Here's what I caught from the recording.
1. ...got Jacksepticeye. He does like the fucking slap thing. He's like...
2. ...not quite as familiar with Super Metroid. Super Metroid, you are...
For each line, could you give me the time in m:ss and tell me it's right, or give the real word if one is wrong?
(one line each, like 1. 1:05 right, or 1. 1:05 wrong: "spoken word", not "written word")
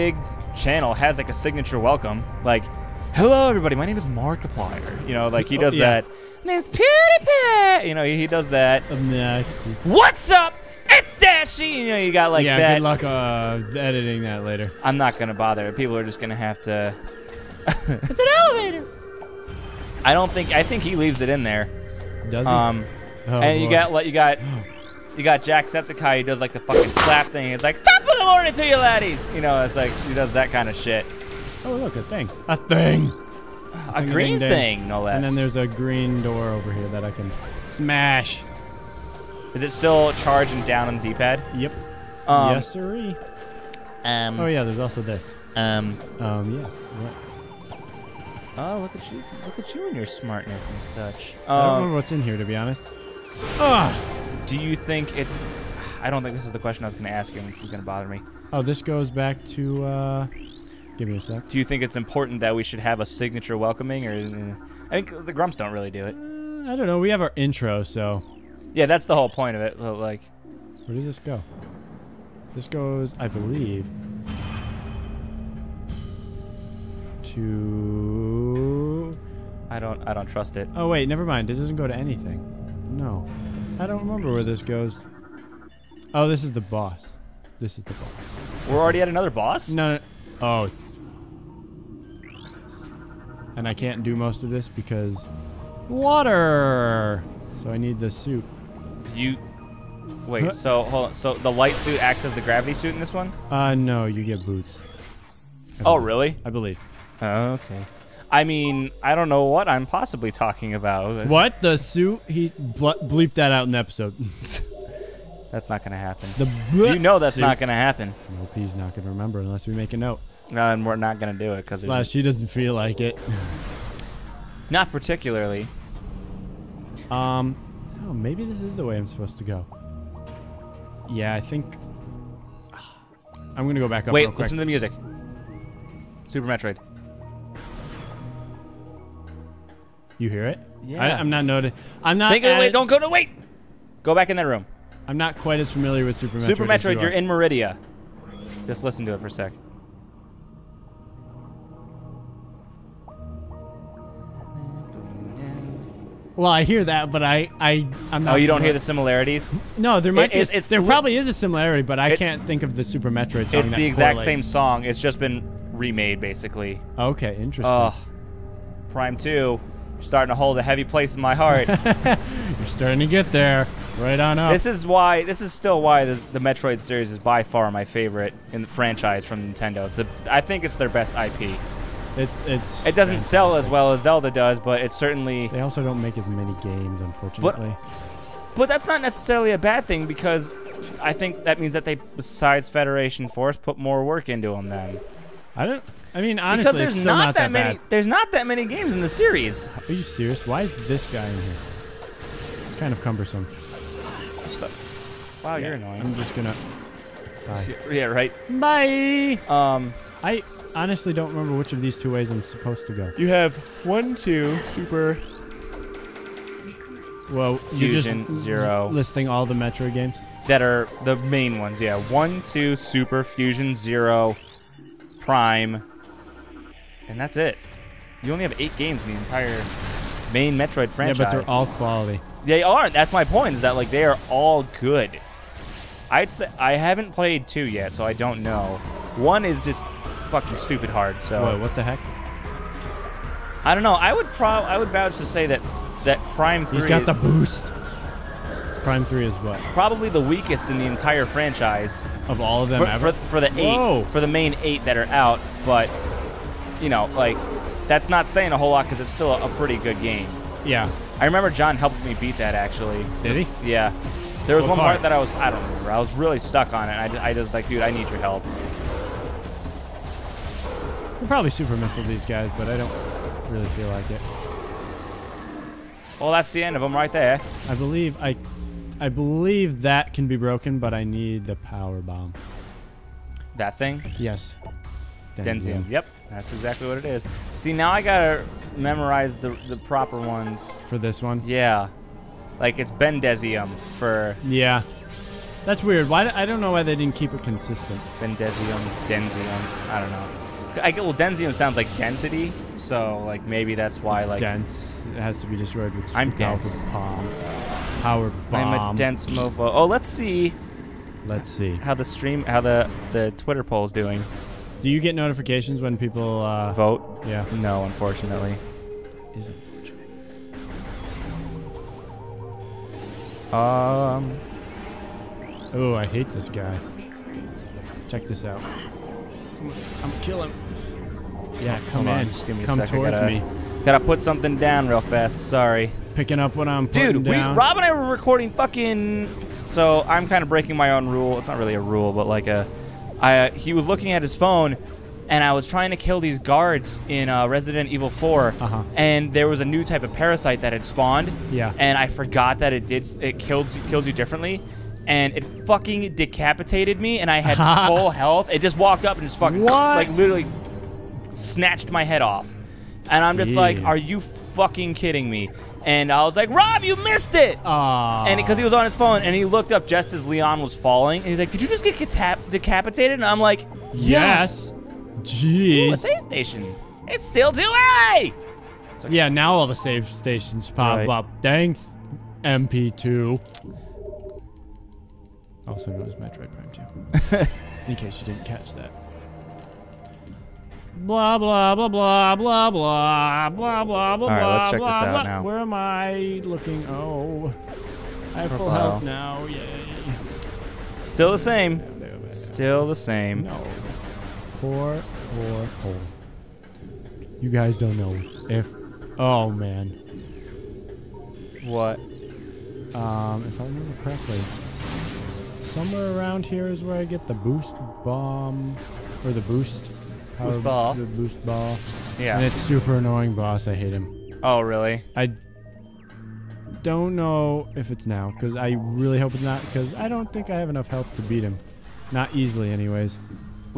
1. 0:25 right
2. 2:25 right.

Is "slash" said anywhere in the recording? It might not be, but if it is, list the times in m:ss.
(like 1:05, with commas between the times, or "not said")
2:01.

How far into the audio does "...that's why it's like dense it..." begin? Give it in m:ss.
5:03.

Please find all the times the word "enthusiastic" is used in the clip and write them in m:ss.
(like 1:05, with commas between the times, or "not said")
not said.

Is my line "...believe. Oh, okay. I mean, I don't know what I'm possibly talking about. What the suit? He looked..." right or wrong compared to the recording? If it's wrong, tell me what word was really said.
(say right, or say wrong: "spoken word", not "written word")
wrong: "bleeped", not "looked".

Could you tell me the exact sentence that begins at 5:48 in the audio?
and there was a new type of parasite that had spawned.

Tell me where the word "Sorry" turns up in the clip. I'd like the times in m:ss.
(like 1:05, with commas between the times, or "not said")
5:35.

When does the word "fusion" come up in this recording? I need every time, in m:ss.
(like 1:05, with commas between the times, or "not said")
3:37, 3:43.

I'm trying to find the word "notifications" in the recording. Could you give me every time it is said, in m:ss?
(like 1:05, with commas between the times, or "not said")
5:15.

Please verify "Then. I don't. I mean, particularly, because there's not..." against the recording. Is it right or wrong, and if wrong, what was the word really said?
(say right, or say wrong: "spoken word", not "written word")
wrong: "honestly", not "particularly".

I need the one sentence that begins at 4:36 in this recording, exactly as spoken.
Well, that's the end of them right there.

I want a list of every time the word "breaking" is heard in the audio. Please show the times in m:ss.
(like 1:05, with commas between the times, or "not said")
5:40.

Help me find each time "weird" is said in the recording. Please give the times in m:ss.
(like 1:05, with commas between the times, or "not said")
4:55.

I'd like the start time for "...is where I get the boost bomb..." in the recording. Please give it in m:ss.
6:56.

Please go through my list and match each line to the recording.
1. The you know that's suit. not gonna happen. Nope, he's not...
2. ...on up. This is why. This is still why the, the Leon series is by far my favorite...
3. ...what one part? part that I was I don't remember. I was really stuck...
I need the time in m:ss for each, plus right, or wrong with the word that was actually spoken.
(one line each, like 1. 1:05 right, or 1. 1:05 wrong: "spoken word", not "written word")
1. 1:56 right
2. 2:54 wrong: "Metroid", not "Leon"
3. 4:24 right.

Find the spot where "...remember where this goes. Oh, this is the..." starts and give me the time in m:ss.
1:23.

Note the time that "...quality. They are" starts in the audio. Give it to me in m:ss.
3:51.